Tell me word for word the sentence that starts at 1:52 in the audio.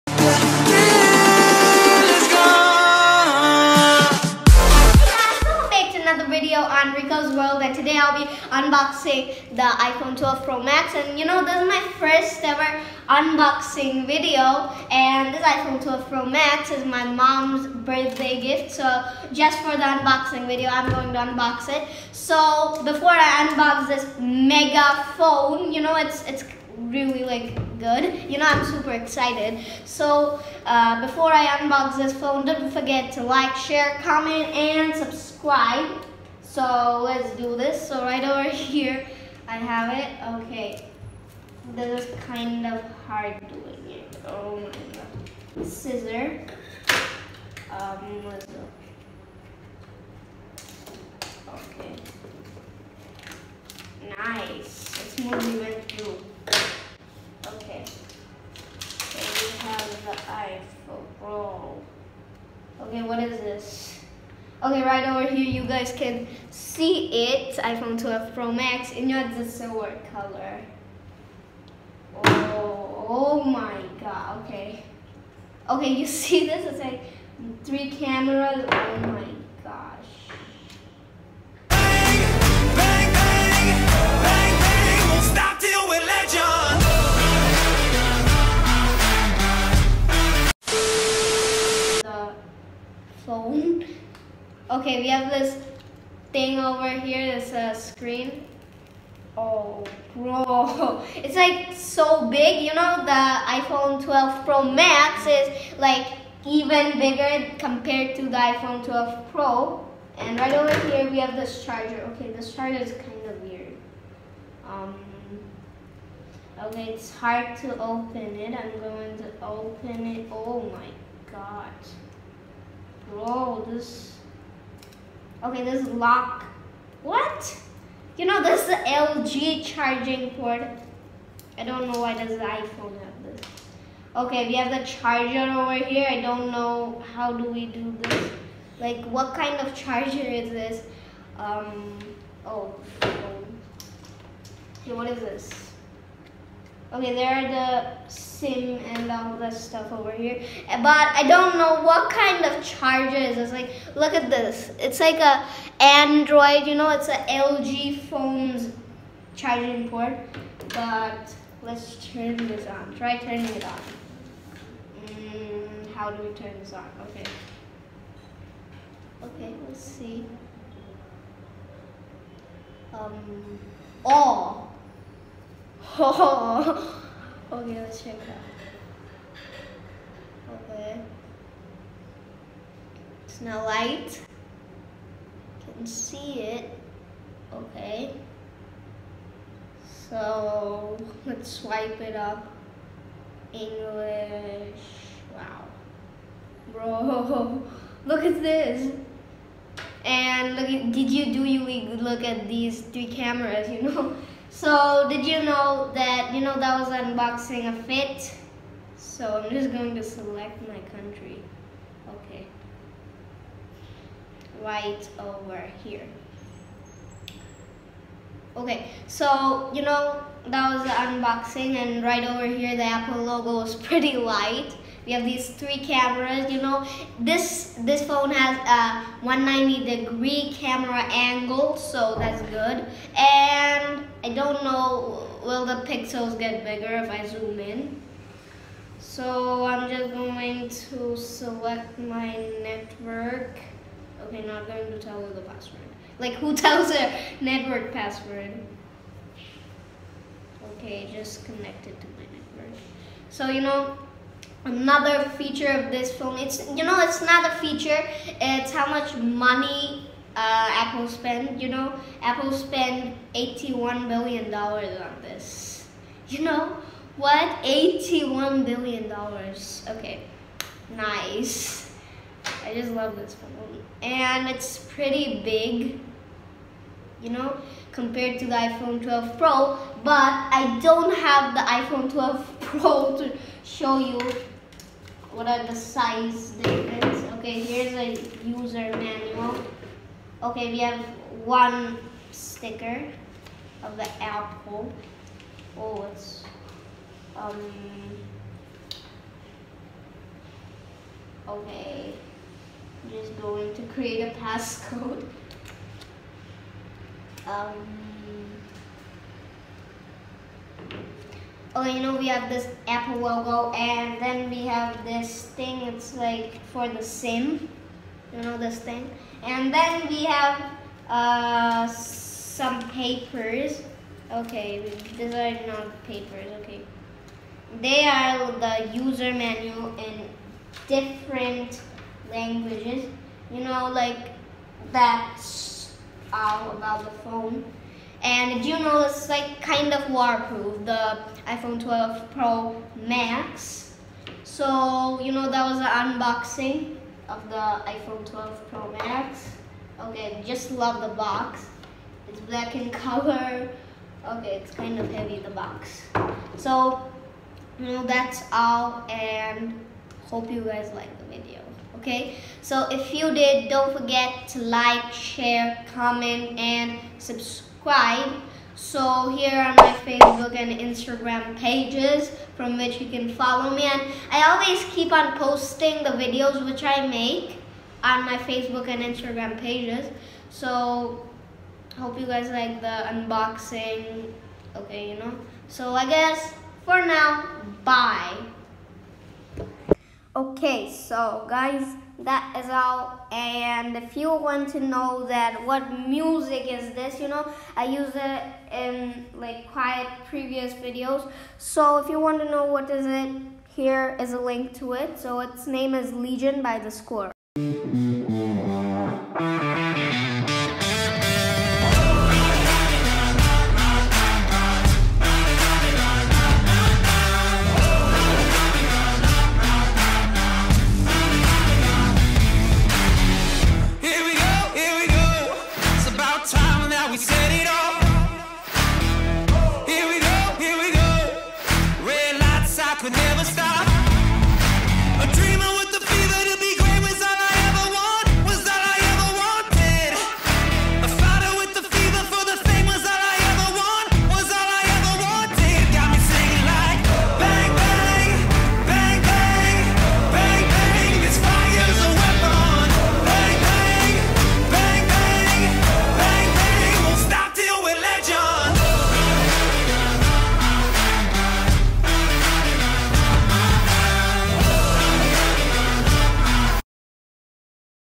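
Okay, this charger is kind of weird.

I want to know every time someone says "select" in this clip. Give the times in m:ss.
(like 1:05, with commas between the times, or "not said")
3:30, 4:01.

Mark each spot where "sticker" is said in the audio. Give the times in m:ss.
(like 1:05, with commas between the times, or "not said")
4:52.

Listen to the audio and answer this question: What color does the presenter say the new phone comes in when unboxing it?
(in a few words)
Silver.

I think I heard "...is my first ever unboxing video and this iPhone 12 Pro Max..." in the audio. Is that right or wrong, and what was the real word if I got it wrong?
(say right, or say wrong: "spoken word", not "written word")
right.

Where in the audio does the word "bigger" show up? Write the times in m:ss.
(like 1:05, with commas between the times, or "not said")
1:46, 3:56.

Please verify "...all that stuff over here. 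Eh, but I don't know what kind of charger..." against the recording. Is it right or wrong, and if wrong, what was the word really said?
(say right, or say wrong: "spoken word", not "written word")
right.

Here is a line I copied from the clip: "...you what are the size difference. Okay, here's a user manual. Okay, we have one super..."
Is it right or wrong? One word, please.
wrong.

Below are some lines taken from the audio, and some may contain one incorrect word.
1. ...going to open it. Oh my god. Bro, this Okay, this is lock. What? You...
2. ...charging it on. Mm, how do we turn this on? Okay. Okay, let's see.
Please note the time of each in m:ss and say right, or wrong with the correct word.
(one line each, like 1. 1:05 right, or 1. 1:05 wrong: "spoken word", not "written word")
1. 1:58 right
2. 2:43 wrong: "turning", not "charging".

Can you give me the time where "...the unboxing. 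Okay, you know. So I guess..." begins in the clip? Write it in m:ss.
6:22.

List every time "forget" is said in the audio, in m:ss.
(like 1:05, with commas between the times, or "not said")
0:32, 6:03.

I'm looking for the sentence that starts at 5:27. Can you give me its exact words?
They are the user manual in different languages.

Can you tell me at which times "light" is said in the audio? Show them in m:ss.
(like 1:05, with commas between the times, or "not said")
3:03, 3:44.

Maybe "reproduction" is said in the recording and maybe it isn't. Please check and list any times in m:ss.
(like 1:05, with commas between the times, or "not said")
not said.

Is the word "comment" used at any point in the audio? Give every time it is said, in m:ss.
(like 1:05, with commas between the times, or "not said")
0:34, 6:05.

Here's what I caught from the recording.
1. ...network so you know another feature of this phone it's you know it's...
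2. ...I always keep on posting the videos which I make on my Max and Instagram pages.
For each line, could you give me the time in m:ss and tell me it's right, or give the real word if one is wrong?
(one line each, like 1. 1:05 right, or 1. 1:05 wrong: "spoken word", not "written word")
1. 4:12 right
2. 6:14 wrong: "Facebook", not "Max".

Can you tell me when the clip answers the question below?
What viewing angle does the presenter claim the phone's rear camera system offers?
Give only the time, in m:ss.
3:49.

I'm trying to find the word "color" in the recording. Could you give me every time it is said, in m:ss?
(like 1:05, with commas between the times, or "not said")
1:10, 5:52.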